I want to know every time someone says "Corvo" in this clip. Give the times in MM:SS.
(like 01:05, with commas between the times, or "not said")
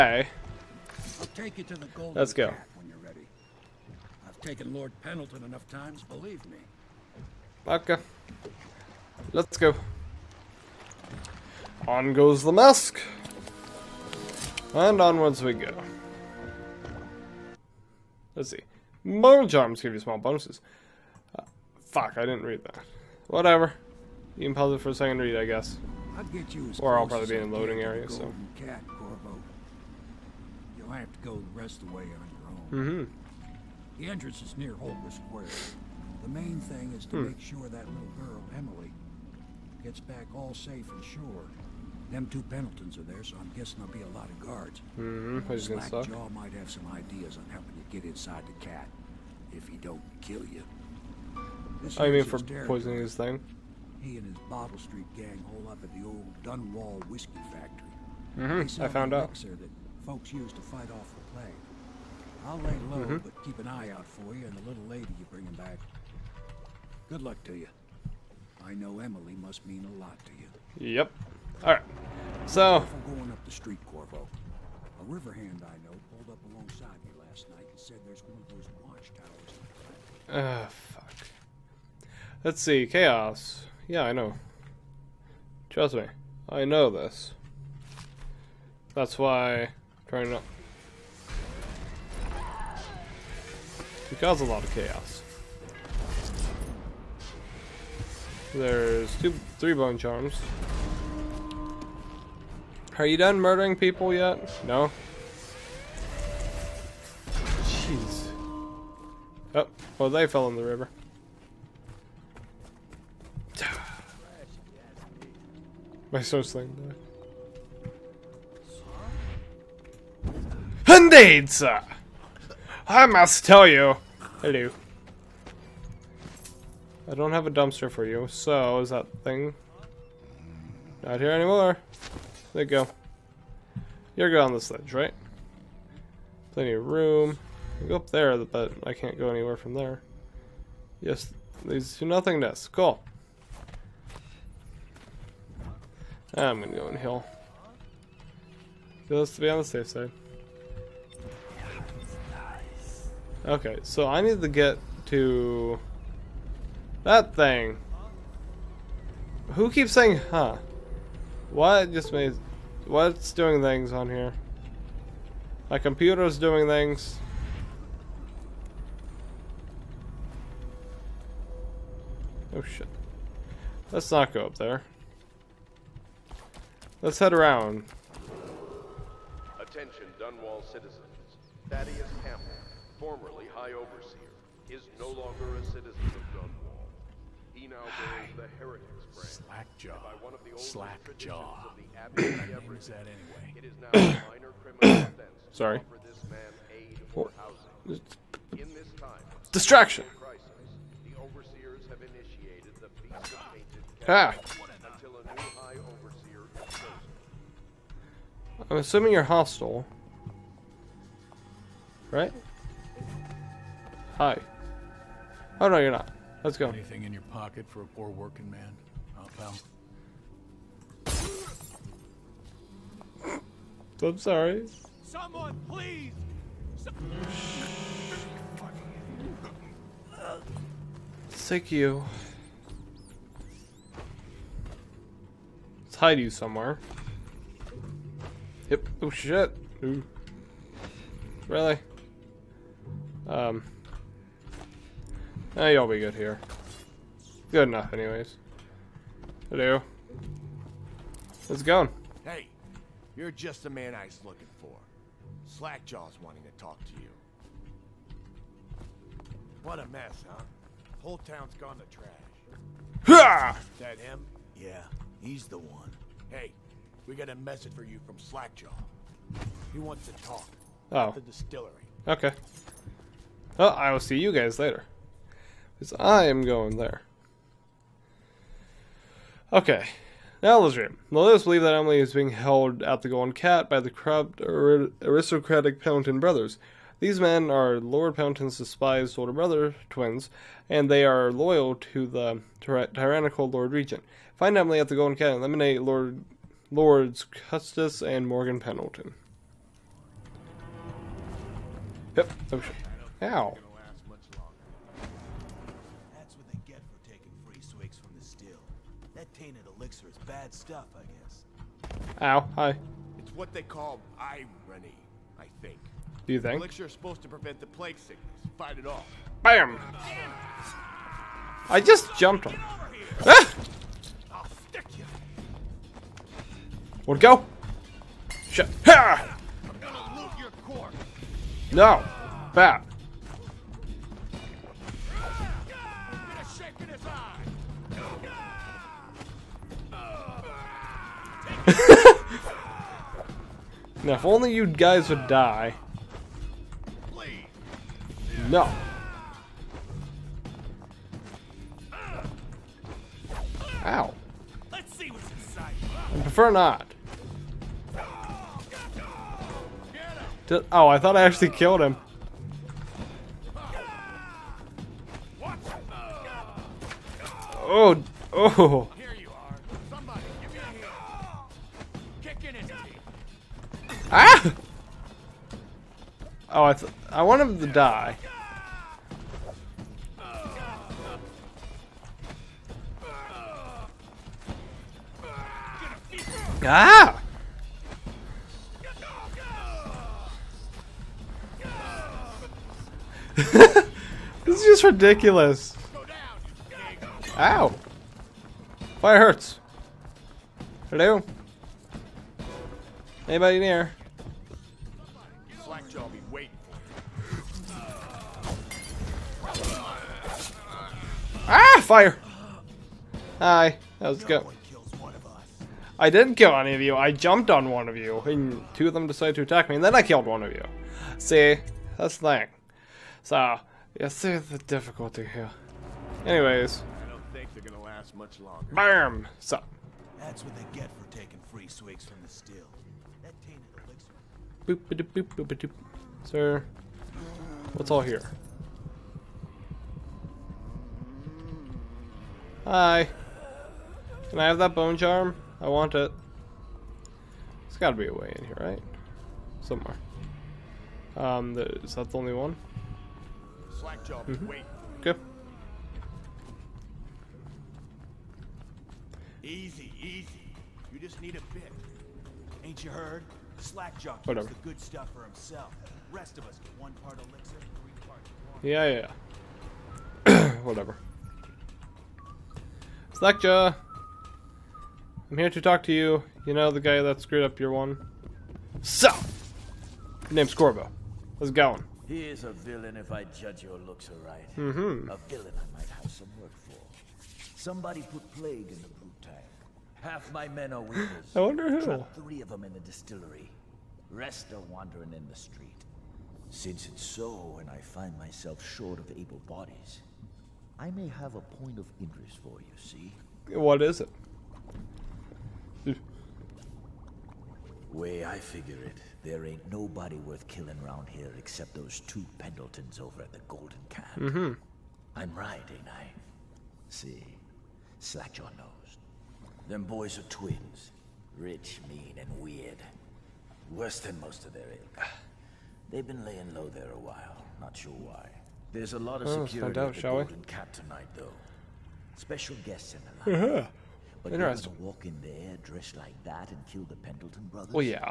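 00:28, 01:13, 08:00.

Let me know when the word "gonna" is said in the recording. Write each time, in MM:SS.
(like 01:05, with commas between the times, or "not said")
02:26, 05:29, 07:07.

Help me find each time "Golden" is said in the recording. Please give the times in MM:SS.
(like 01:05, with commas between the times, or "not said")
04:43, 04:54, 08:33, 08:50.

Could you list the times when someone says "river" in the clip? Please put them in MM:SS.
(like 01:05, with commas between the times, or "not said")
01:15, 01:50.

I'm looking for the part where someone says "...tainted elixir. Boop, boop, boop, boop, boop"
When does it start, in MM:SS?
07:13.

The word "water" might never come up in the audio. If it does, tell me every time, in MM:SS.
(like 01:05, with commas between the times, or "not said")
07:48.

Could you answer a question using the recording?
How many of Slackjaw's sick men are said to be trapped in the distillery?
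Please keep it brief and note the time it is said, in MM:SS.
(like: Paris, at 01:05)
3, at 08:11.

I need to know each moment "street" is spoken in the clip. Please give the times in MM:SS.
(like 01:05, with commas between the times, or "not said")
00:54, 01:13, 08:15.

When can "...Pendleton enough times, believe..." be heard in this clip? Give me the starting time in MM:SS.
00:04.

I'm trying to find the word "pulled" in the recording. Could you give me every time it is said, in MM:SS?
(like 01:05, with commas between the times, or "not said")
01:16.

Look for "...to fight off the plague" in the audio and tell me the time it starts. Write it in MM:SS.
01:00.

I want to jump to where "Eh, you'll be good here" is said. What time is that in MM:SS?
04:05.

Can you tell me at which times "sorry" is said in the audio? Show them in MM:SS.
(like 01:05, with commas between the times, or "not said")
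03:15, 03:44.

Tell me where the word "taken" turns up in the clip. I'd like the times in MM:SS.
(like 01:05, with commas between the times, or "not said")
00:04.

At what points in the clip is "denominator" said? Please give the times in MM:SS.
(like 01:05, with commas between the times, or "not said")
not said.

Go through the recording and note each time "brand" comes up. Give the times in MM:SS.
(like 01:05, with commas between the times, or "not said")
03:09.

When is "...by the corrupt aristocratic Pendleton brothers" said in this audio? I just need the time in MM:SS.
04:43.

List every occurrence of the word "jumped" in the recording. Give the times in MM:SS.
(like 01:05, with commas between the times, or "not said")
05:22, 06:57.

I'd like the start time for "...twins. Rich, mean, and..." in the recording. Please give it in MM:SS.
08:40.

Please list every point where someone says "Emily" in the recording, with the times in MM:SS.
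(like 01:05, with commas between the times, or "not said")
00:38, 01:08, 04:41, 04:54.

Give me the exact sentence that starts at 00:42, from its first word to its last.
Them two Pendletons are there, so I'm guessing there'll be a lot of guards.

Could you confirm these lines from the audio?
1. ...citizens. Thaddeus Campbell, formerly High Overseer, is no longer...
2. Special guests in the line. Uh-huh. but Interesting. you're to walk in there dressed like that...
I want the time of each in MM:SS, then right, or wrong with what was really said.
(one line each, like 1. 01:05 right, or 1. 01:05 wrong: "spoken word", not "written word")
1. 03:00 right
2. 08:52 right.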